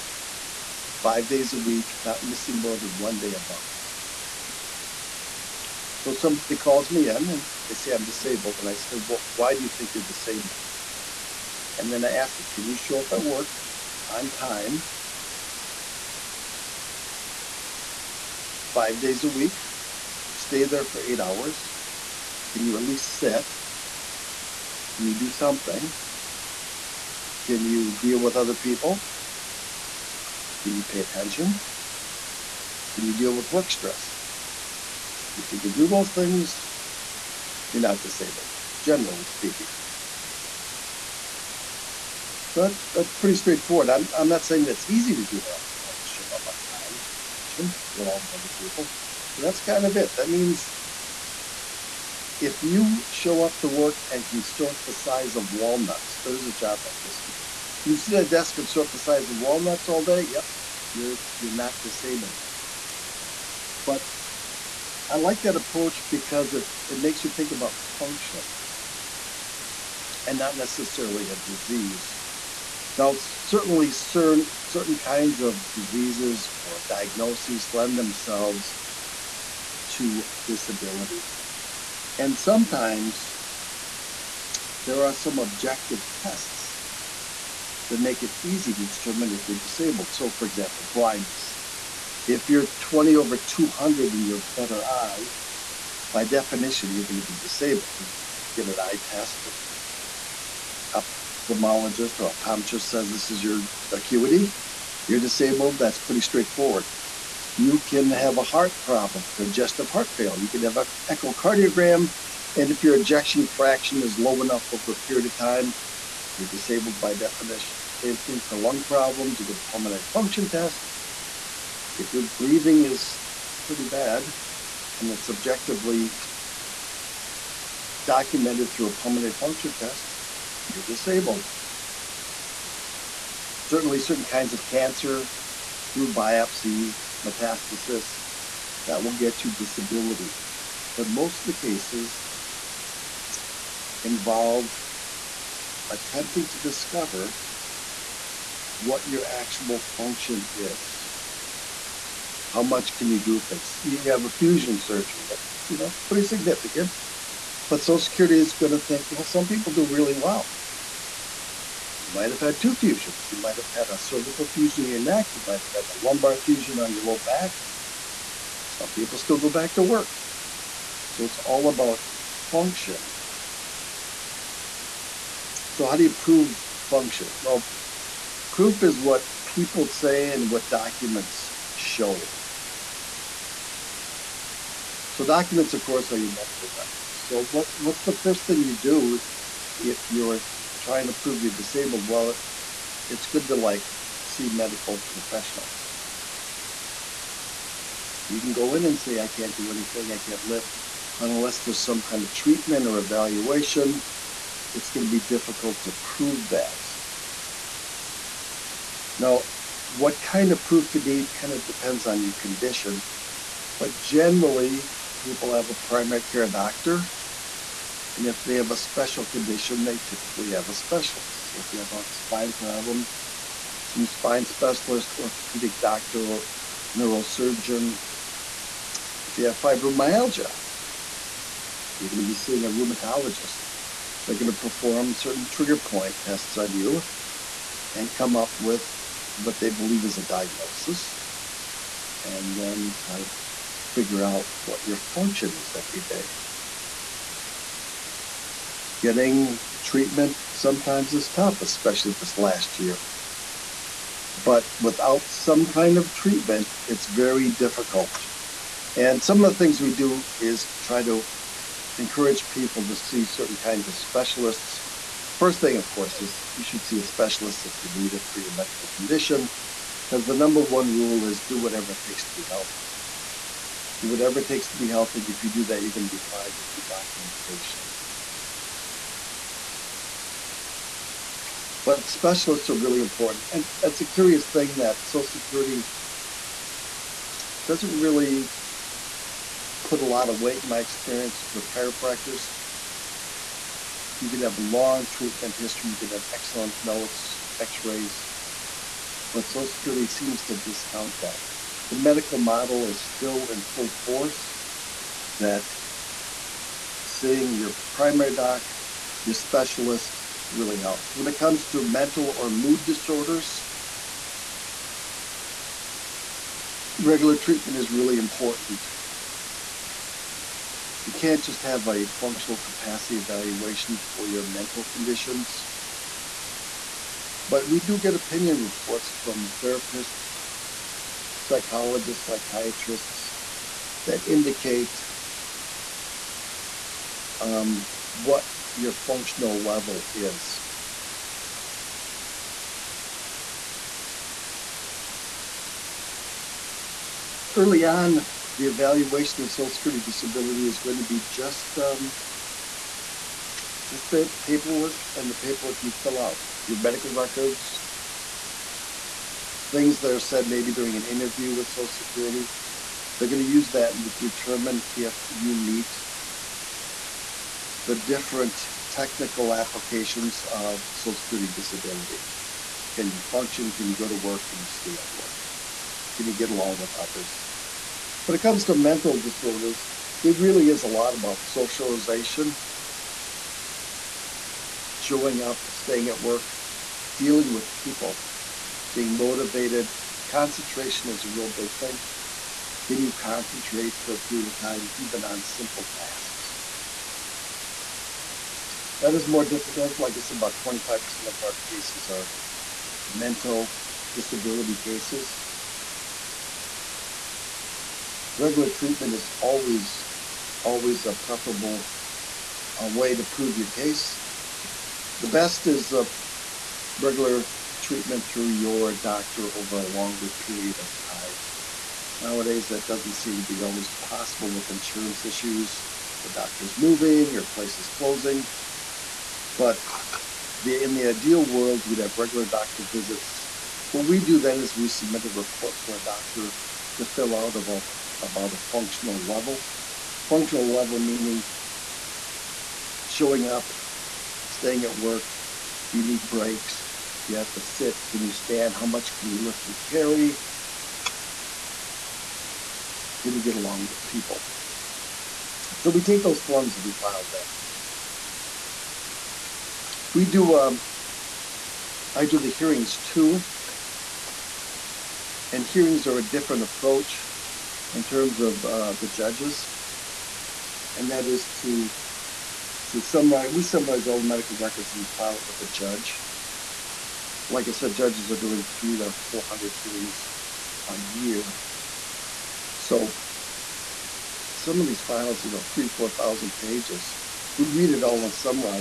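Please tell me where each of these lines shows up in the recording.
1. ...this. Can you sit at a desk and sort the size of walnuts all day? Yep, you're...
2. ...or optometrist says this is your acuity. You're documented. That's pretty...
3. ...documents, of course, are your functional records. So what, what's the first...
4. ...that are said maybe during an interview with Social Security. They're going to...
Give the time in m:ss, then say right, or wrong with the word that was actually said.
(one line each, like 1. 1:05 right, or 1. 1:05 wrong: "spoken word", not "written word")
1. 0:57 right
2. 1:42 wrong: "disabled", not "documented"
3. 3:05 wrong: "medical", not "functional"
4. 5:59 right.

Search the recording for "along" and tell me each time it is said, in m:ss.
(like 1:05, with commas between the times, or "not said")
0:47, 6:16, 7:33.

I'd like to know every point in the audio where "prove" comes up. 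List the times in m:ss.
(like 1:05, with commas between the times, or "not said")
2:56, 3:11, 3:26, 6:53.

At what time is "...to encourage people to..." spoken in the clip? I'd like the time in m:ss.
4:21.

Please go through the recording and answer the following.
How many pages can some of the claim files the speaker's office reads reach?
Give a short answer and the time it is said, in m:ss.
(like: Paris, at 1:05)
3,000 to 4,000, at 8:05.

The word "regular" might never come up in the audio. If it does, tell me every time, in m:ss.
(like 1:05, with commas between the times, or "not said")
5:16, 6:48, 6:56, 7:12.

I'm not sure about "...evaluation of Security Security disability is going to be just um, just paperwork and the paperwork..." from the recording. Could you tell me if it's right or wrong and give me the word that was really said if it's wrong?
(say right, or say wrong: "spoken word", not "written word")
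wrong: "Social", not "Security".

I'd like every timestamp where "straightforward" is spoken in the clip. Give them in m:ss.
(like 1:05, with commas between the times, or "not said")
0:43, 1:46.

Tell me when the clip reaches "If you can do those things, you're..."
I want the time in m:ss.
0:35.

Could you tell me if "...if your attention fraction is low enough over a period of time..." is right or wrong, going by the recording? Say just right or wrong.
wrong.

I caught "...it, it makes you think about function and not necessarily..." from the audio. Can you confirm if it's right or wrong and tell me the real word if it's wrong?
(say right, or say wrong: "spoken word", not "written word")
right.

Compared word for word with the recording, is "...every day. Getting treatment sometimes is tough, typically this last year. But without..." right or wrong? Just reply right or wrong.
wrong.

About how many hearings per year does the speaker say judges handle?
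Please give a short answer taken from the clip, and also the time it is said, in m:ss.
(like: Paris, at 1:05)
300 to 400, at 7:58.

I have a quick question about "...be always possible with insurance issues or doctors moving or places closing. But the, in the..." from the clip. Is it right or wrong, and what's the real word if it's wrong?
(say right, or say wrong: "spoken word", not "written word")
right.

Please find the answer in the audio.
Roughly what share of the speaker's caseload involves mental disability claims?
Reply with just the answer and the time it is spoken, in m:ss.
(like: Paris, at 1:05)
25%, at 6:40.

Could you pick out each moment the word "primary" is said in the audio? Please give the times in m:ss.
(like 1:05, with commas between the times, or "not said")
3:35, 5:07.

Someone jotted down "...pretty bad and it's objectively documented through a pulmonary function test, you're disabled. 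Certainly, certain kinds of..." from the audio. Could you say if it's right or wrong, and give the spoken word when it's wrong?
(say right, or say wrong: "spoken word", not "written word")
right.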